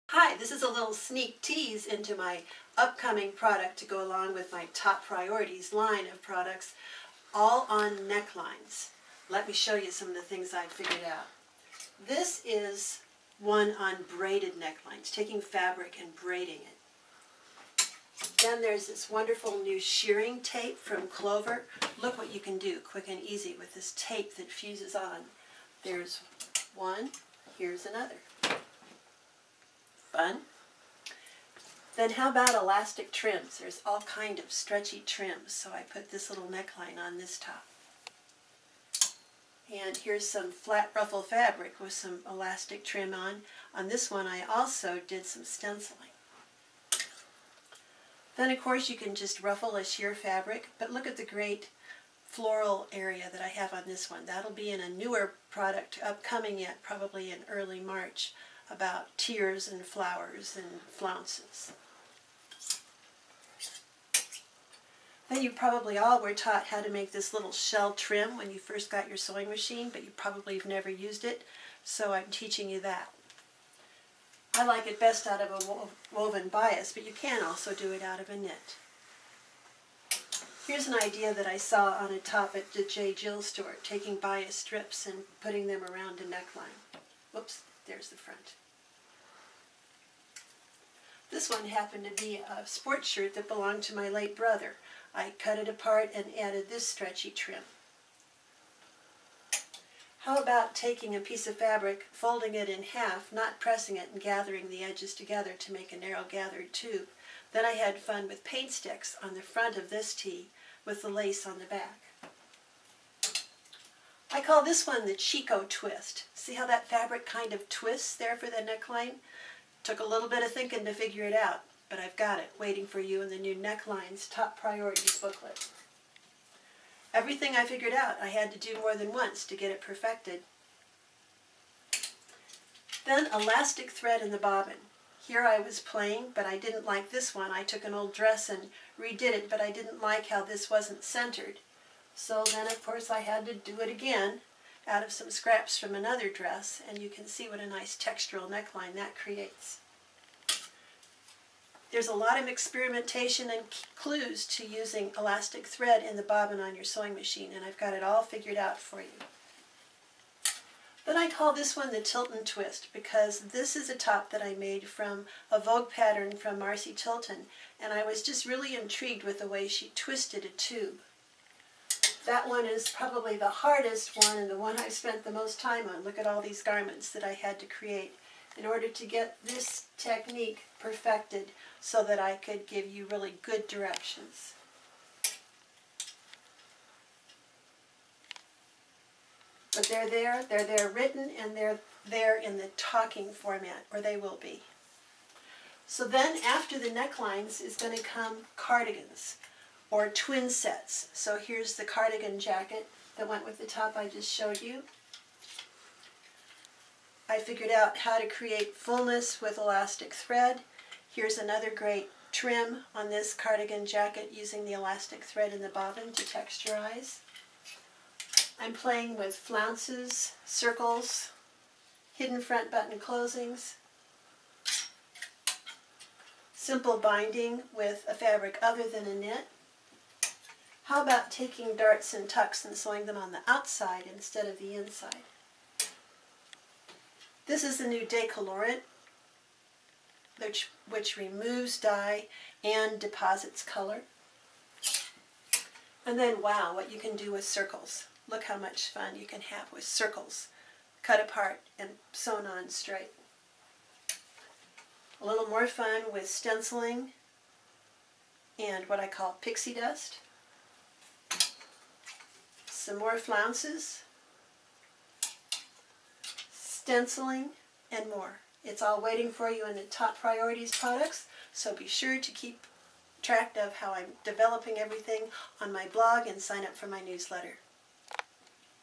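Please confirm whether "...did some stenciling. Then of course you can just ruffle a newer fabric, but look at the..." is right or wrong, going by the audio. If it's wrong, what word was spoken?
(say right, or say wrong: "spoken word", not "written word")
wrong: "sheer", not "newer".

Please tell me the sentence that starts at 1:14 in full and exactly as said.
I like it best out of a woven bias, but you can also do it out of a knit.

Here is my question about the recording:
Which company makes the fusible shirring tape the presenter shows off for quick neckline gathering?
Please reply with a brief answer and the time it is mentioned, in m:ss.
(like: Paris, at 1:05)
Clover, at 0:21.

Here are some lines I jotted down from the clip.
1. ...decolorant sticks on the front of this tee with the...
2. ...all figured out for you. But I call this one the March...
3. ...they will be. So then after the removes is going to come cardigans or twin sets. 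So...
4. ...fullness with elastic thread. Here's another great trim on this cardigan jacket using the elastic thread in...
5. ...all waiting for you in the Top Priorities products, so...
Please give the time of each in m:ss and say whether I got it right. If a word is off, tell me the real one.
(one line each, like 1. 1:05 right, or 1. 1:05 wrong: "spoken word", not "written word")
1. 1:48 wrong: "paint", not "decolorant"
2. 2:38 wrong: "Tilton", not "March"
3. 3:14 wrong: "necklines", not "removes"
4. 3:28 right
5. 4:28 right.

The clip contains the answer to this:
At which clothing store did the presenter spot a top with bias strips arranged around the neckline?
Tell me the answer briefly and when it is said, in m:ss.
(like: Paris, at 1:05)
J. Jill, at 1:22.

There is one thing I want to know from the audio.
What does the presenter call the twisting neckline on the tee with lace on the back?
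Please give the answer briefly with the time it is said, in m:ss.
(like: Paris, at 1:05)
Chico twist, at 1:55.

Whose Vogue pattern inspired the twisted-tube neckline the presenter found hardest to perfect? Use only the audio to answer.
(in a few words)
Marcy Tilton.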